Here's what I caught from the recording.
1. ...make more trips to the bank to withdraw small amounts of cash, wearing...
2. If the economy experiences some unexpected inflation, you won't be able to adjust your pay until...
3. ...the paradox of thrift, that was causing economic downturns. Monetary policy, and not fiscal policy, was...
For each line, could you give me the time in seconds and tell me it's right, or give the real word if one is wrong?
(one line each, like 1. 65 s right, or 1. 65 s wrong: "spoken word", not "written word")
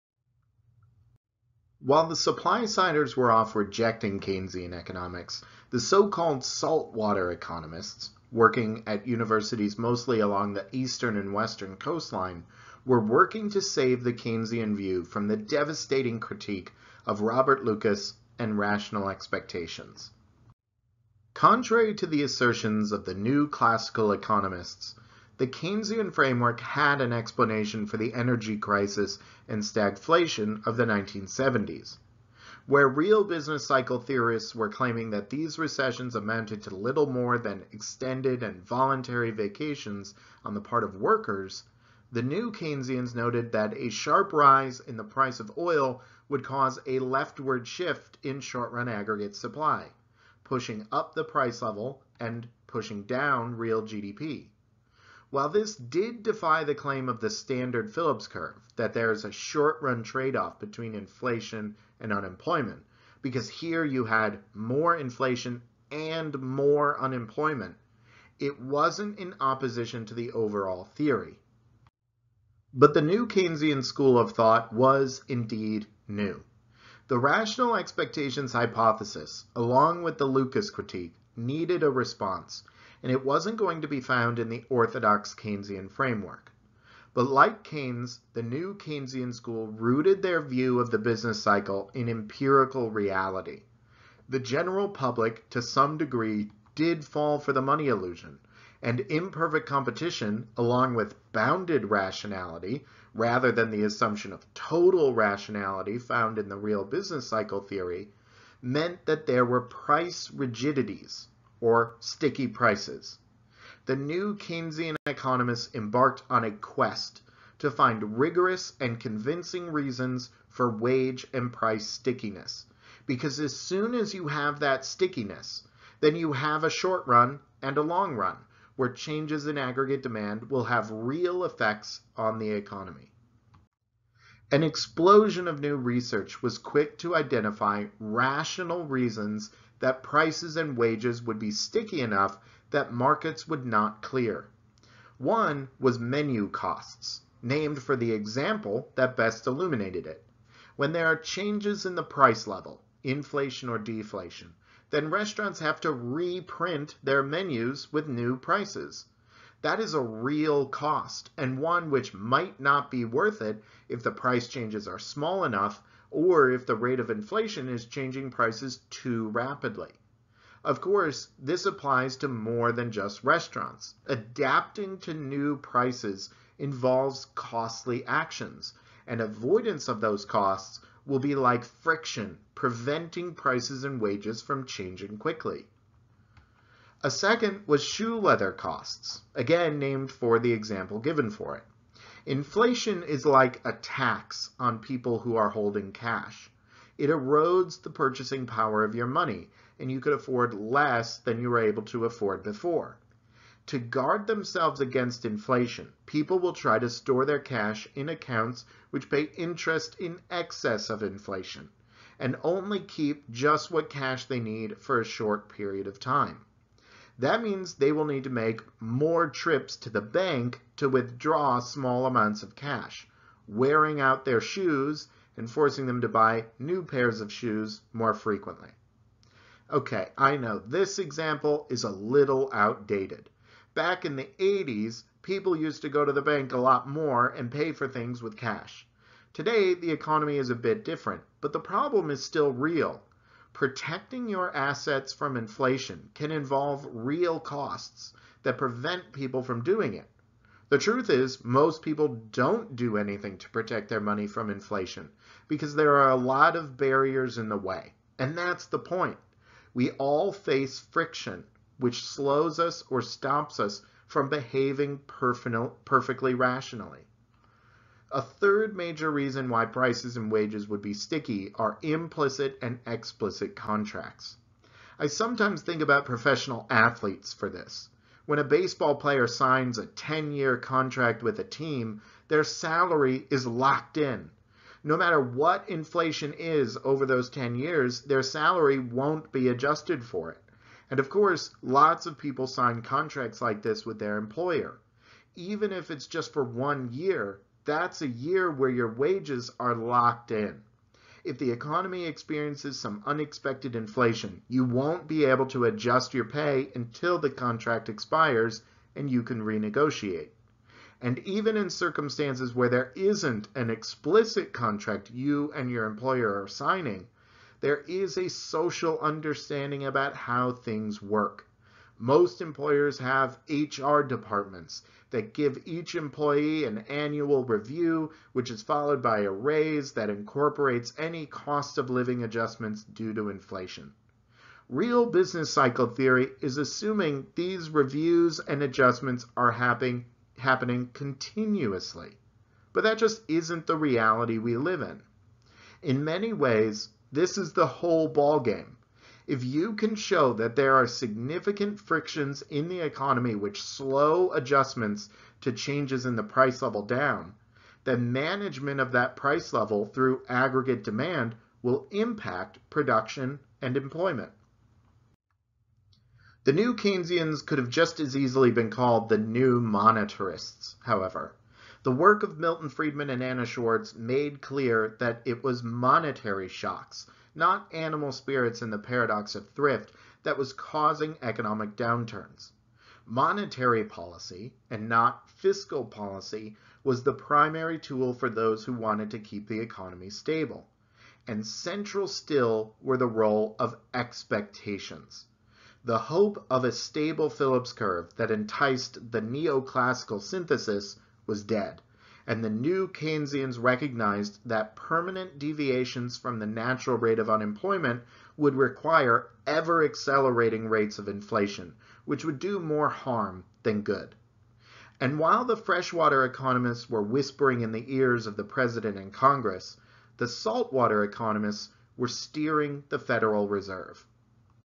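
1. 218 s right
2. 301 s right
3. 378 s right.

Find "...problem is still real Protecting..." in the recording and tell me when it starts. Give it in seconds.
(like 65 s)
241 s.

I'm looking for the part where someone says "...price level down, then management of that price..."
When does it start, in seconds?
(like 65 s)
356 s.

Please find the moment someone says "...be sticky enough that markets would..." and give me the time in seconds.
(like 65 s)
141 s.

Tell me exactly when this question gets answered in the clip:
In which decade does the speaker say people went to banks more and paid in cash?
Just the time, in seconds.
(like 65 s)
234 s.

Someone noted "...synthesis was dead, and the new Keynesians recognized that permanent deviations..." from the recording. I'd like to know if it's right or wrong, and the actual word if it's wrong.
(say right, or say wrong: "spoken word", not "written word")
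right.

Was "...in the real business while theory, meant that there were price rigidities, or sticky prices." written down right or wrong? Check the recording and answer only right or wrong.
wrong.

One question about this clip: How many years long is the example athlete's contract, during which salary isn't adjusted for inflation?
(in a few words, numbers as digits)
10.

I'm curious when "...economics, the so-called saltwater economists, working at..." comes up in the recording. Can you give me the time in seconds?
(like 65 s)
4 s.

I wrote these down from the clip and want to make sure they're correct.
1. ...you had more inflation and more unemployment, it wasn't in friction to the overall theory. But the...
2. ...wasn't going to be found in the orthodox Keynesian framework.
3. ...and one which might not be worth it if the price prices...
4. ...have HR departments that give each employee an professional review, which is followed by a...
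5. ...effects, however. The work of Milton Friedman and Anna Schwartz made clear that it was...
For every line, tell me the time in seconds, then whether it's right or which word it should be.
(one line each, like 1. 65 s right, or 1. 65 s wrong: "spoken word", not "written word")
1. 63 s wrong: "opposition", not "friction"
2. 83 s right
3. 161 s wrong: "changes", not "prices"
4. 322 s wrong: "annual", not "professional"
5. 369 s wrong: "monetarists", not "effects".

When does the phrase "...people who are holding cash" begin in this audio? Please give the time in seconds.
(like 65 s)
194 s.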